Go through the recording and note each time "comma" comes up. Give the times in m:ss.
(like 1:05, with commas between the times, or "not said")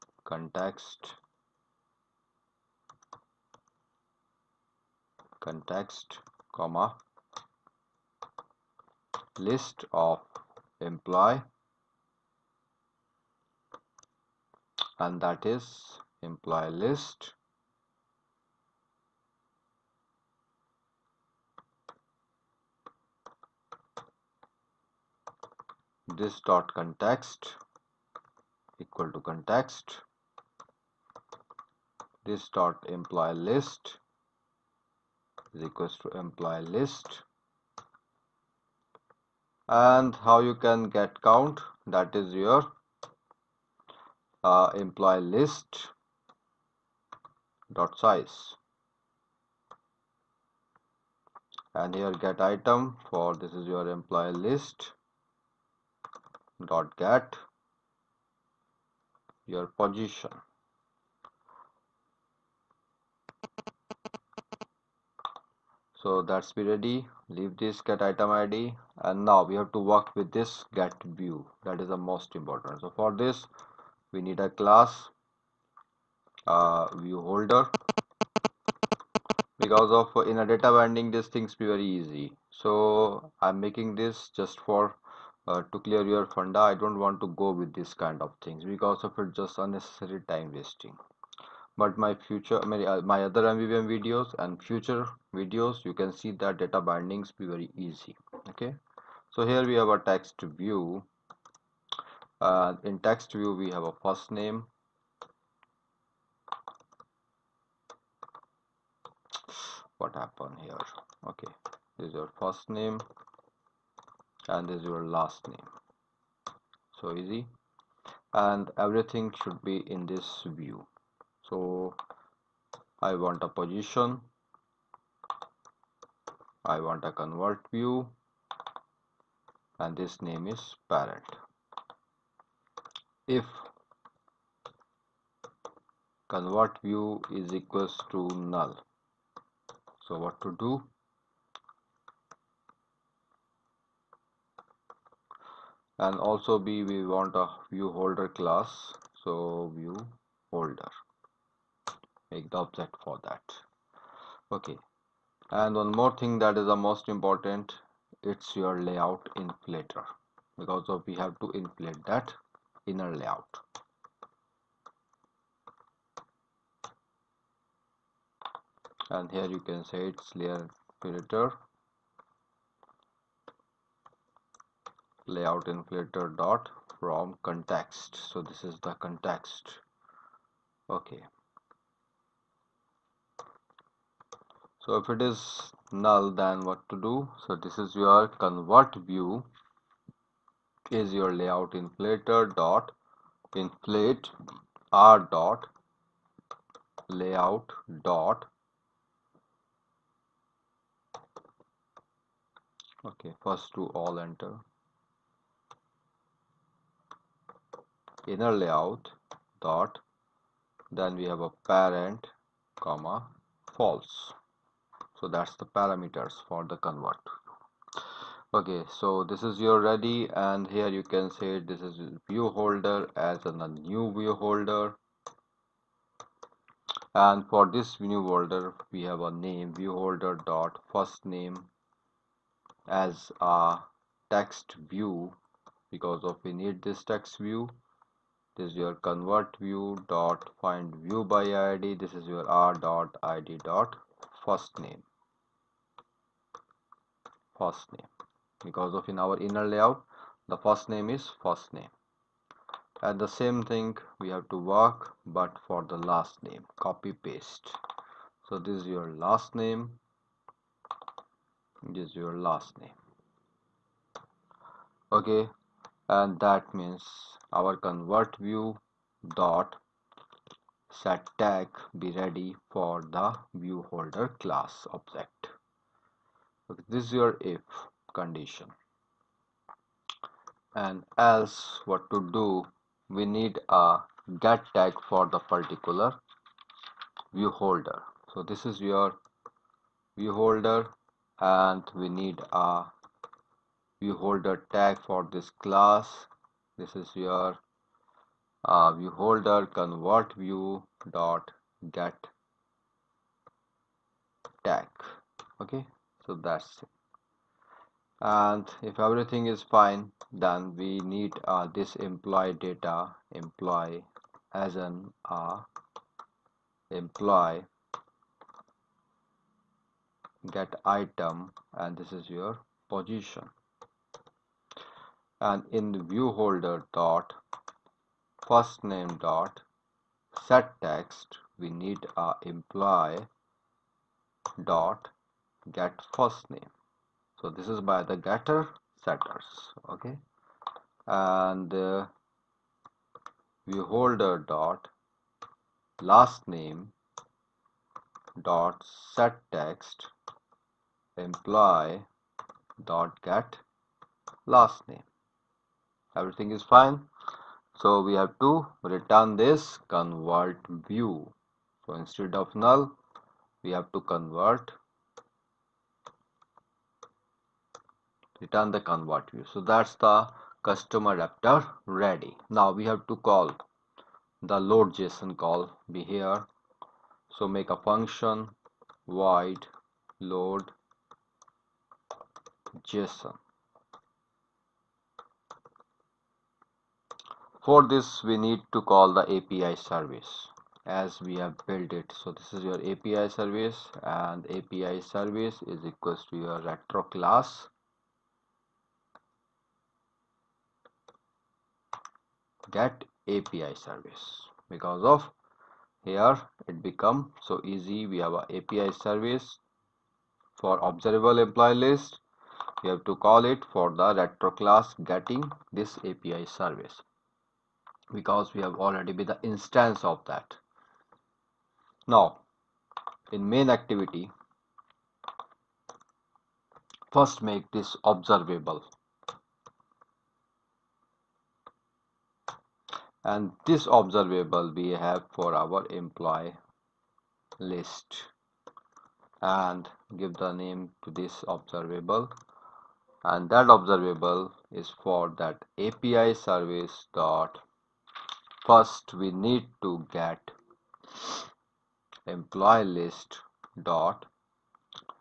0:06, 3:32.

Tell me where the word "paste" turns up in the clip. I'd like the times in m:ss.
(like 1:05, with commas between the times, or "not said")
4:17.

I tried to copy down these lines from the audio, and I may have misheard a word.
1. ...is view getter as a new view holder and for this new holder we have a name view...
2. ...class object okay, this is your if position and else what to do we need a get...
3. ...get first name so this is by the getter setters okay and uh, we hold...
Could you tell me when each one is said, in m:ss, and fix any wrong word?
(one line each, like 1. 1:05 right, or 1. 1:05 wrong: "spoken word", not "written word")
1. 3:41 wrong: "holder", not "getter"
2. 4:34 wrong: "condition", not "position"
3. 5:35 right.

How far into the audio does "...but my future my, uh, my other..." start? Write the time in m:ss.
1:31.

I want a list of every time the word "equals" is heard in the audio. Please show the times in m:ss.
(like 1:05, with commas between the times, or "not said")
0:28, 0:35, 2:17, 6:35.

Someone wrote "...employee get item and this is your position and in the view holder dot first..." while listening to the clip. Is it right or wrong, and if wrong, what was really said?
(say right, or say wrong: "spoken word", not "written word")
right.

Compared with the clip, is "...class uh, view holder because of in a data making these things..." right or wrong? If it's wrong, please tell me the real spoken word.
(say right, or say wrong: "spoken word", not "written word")
wrong: "binding", not "making".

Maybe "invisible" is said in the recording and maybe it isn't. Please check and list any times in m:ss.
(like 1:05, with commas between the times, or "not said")
not said.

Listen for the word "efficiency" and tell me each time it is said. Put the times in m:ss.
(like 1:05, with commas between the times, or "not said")
not said.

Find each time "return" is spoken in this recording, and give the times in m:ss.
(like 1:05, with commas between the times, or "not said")
5:58, 6:08.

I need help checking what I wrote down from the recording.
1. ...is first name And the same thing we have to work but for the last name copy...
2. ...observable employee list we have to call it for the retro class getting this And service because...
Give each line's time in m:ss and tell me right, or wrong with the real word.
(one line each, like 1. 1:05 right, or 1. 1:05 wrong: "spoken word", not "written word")
1. 4:11 right
2. 6:50 wrong: "API", not "And".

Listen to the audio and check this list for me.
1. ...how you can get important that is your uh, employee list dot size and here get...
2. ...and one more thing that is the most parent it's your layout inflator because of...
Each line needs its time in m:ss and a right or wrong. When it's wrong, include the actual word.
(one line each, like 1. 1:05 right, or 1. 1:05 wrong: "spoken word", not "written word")
1. 0:40 wrong: "count", not "important"
2. 2:35 wrong: "important", not "parent".